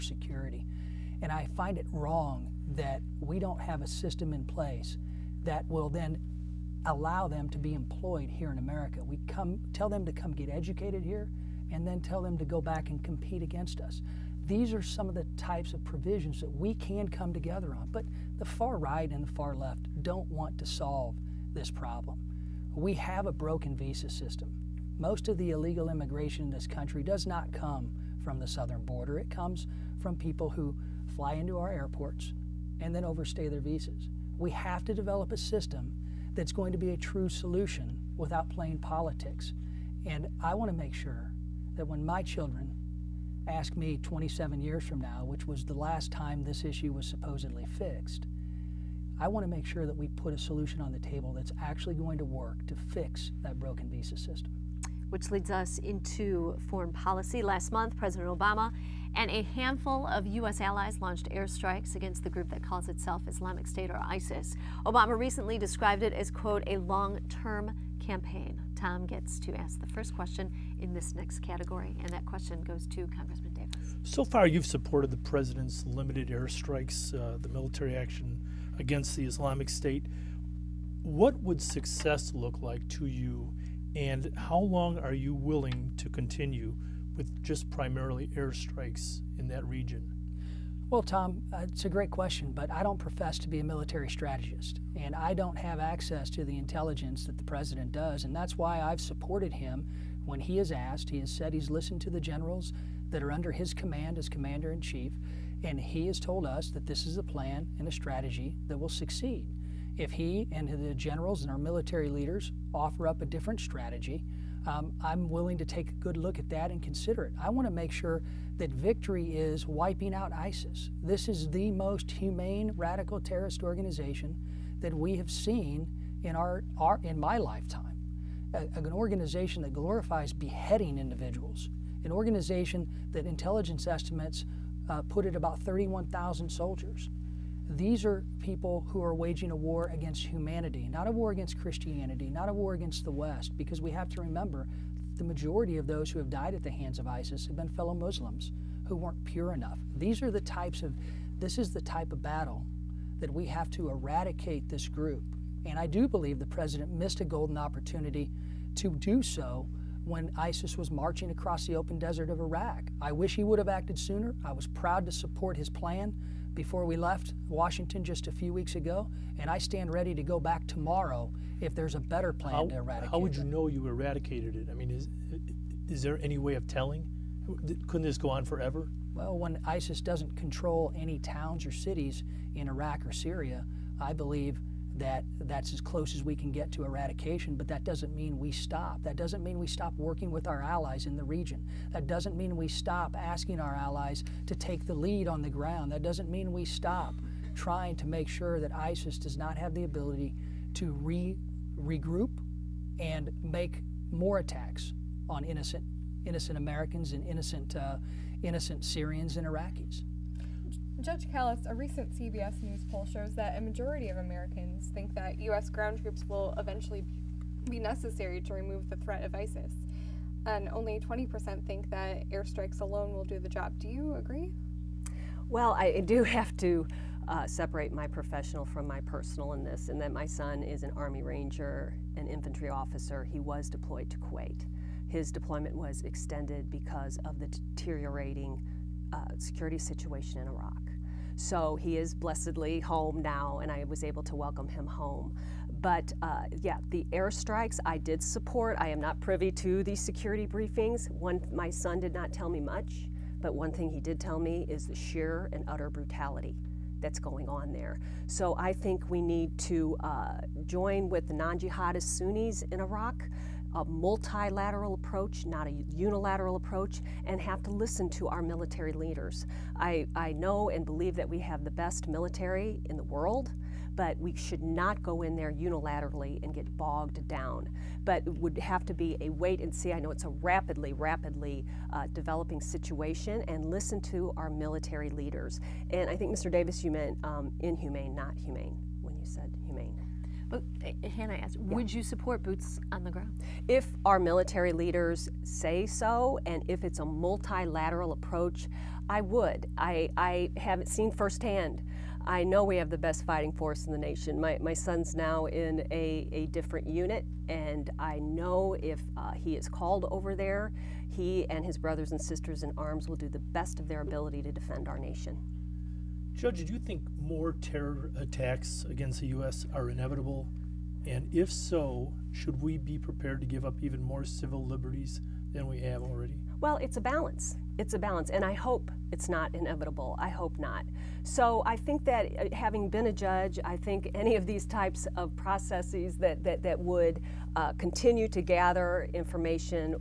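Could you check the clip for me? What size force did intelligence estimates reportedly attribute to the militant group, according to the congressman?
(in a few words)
31,000 soldiers.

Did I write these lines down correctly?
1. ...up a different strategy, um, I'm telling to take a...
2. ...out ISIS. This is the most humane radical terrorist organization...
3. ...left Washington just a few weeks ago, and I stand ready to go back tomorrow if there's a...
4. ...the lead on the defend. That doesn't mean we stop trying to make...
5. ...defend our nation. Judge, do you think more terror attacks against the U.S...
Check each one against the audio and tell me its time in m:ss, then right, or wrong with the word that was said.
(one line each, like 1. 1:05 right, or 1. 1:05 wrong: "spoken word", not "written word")
1. 1:53 wrong: "willing", not "telling"
2. 2:00 right
3. 2:46 right
4. 3:14 wrong: "ground", not "defend"
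5. 5:14 right.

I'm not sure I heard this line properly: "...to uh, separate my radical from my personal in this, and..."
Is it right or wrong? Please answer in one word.
wrong.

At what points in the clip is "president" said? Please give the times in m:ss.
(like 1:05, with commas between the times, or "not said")
0:57, 1:15, 1:37, 2:36.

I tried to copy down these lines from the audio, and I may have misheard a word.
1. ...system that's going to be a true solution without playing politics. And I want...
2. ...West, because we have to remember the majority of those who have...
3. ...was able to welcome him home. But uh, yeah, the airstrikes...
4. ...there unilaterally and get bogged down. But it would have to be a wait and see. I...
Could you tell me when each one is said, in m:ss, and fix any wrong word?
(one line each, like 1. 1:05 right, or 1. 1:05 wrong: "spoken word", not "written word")
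1. 0:35 right
2. 2:23 right
3. 4:03 right
4. 4:35 right.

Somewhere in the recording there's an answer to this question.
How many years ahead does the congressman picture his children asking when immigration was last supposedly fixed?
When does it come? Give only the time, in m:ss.
0:44.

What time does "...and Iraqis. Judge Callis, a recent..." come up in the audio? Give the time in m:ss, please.
3:29.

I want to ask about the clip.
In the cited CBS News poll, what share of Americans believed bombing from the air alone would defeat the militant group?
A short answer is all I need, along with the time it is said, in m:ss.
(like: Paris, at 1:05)
20%, at 3:41.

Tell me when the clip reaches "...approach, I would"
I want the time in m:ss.
4:58.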